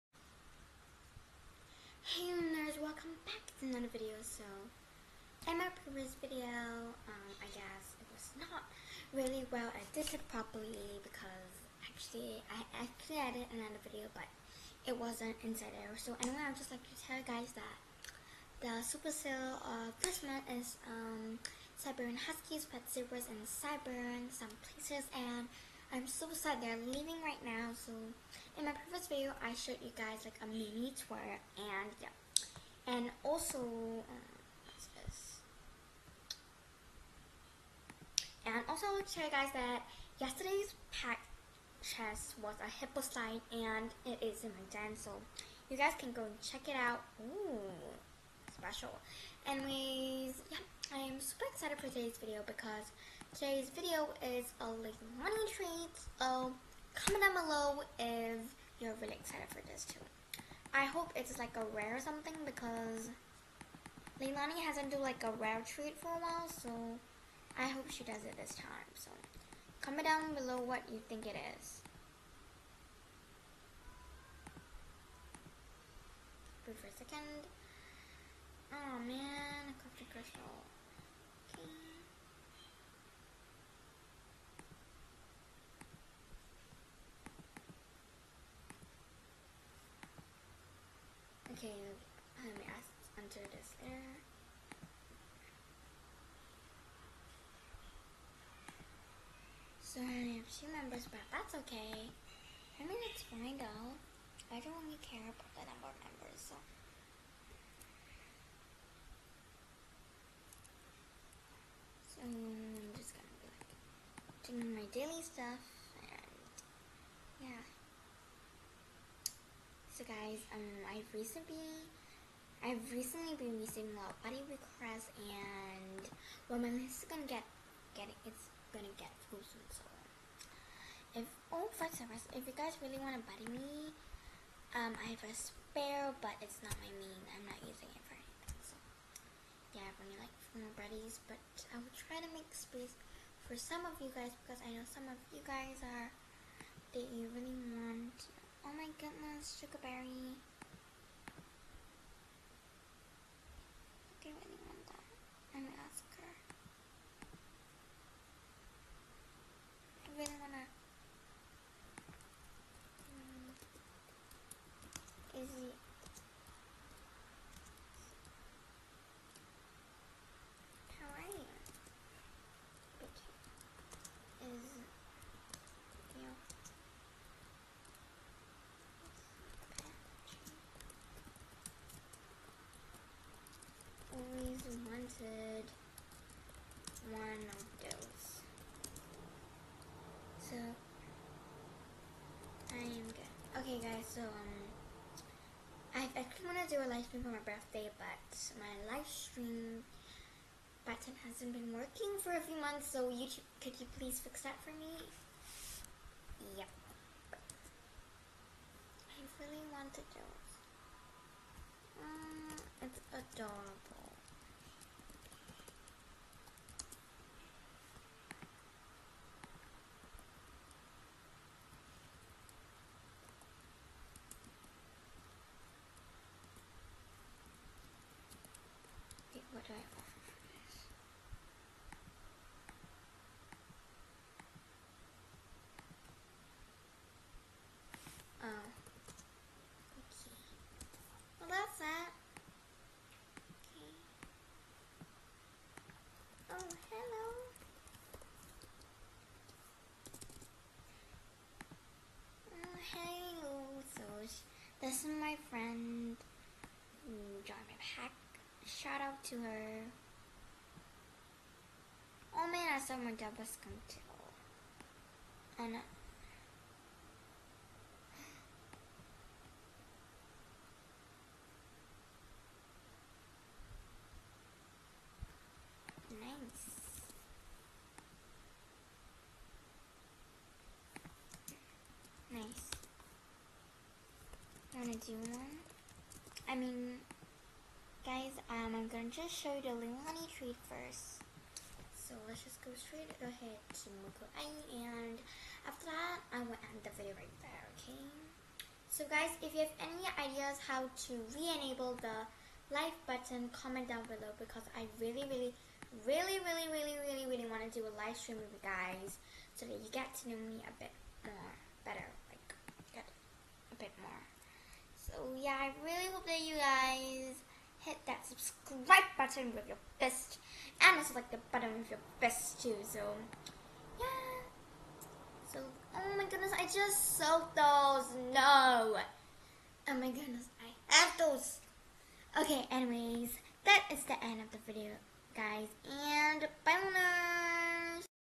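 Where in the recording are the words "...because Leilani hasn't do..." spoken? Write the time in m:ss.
1:02.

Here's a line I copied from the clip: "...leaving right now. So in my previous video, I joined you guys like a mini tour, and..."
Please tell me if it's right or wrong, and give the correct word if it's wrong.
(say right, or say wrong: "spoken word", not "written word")
wrong: "showed", not "joined".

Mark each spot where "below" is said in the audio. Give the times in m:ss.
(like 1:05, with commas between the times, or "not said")
0:57, 1:10, 5:04.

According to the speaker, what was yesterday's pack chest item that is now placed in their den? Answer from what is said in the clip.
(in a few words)
hippo sign.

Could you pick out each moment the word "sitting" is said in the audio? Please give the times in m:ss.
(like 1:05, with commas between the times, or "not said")
not said.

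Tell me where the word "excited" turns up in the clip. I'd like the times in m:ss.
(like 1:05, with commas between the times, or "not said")
0:51, 0:59.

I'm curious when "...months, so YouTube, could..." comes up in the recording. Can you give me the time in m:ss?
3:22.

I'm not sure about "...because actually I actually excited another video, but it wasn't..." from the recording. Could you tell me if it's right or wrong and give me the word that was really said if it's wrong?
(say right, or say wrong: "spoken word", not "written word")
wrong: "edited", not "excited".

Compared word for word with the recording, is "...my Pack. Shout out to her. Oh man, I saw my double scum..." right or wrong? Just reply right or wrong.
right.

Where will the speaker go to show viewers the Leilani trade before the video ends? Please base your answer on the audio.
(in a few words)
Moko.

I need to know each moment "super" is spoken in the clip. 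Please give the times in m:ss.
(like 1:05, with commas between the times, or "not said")
0:18, 0:51.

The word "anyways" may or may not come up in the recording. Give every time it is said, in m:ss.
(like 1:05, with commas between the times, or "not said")
0:16, 0:49, 5:32.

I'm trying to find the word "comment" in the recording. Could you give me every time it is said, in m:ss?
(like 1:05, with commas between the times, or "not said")
0:56, 1:09, 5:03.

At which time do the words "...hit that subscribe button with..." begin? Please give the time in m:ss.
5:17.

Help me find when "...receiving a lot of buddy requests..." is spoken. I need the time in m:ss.
2:03.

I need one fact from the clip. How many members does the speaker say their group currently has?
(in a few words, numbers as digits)
2.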